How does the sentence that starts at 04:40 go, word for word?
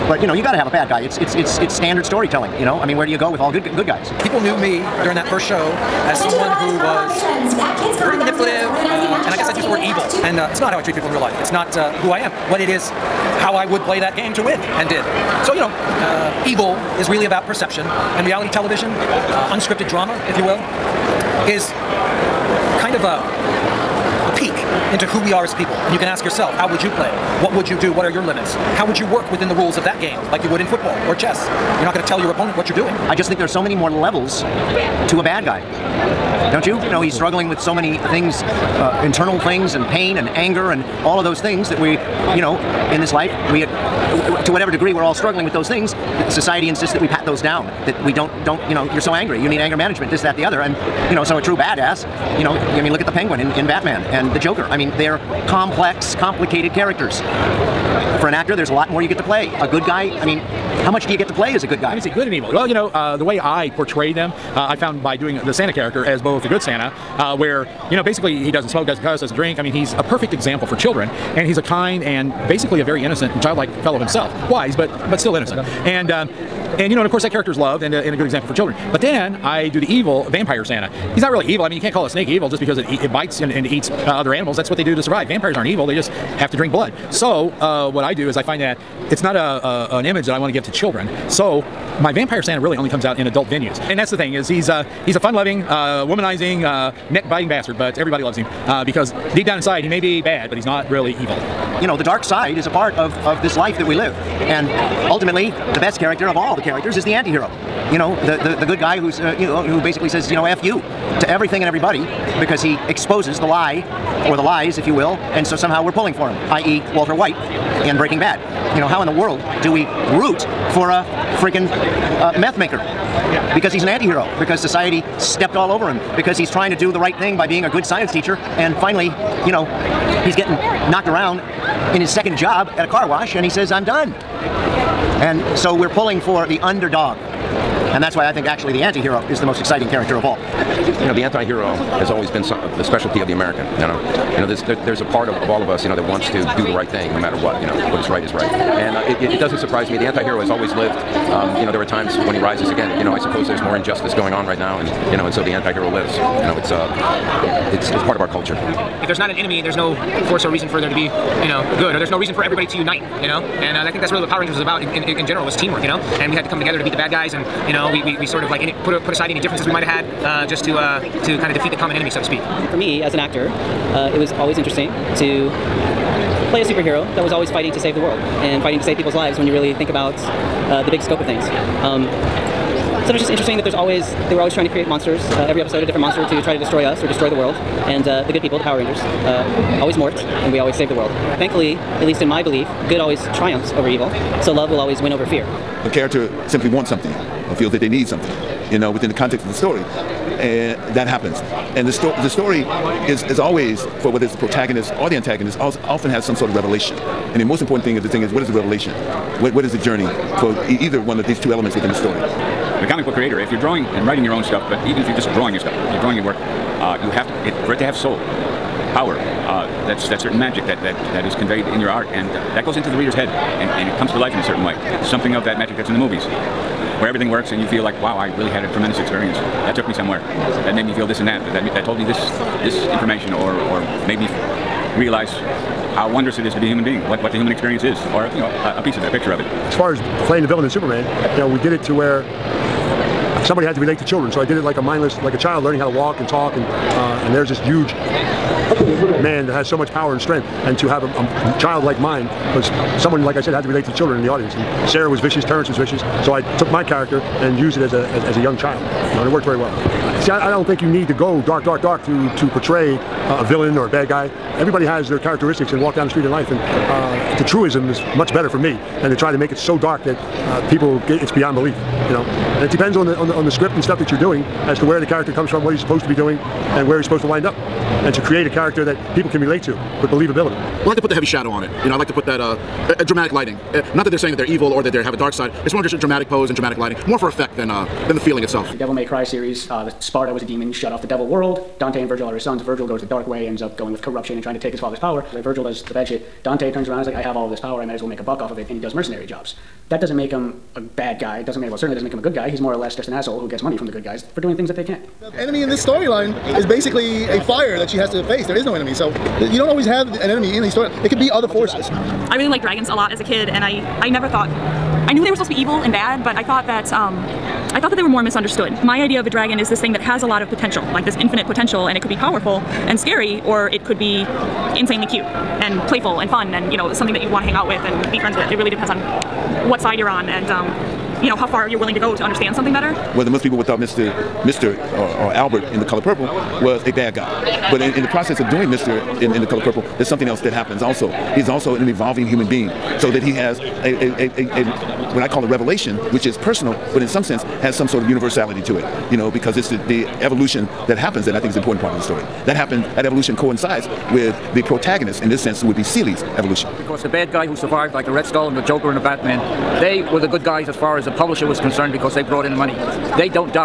Well, I like to put the heavy shadow on it.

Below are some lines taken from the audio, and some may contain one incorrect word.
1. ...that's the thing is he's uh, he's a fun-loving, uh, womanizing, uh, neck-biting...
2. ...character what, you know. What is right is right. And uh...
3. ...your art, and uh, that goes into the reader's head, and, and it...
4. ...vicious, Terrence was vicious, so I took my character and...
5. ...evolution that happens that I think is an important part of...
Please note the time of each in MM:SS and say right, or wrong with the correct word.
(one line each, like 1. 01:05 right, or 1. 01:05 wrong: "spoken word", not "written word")
1. 01:33 right
2. 02:27 wrong: "matter", not "character"
3. 03:41 right
4. 04:15 right
5. 05:50 right.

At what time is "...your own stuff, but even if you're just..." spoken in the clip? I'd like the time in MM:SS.
03:34.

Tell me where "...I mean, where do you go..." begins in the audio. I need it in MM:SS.
00:02.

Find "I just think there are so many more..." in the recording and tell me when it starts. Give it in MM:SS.
00:33.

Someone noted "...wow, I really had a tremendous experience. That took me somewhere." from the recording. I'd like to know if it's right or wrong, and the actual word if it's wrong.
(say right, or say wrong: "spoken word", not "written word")
right.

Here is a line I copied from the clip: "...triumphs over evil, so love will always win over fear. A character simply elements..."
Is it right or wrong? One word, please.
wrong.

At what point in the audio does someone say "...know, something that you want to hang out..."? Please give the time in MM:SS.
05:26.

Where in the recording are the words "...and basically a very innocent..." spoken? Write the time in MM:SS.
01:12.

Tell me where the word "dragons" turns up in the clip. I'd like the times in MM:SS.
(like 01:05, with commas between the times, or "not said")
05:12, 05:19.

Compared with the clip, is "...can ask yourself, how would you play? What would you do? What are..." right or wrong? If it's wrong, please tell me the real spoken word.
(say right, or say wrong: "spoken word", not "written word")
right.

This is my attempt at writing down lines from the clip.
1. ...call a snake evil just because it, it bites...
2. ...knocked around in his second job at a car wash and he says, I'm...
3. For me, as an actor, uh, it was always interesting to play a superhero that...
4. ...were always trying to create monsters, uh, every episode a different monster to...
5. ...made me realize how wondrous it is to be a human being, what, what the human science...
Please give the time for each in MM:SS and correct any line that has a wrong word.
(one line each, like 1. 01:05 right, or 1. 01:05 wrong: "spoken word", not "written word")
1. 01:21 right
2. 02:10 right
3. 02:52 right
4. 03:04 right
5. 03:54 wrong: "experience", not "science".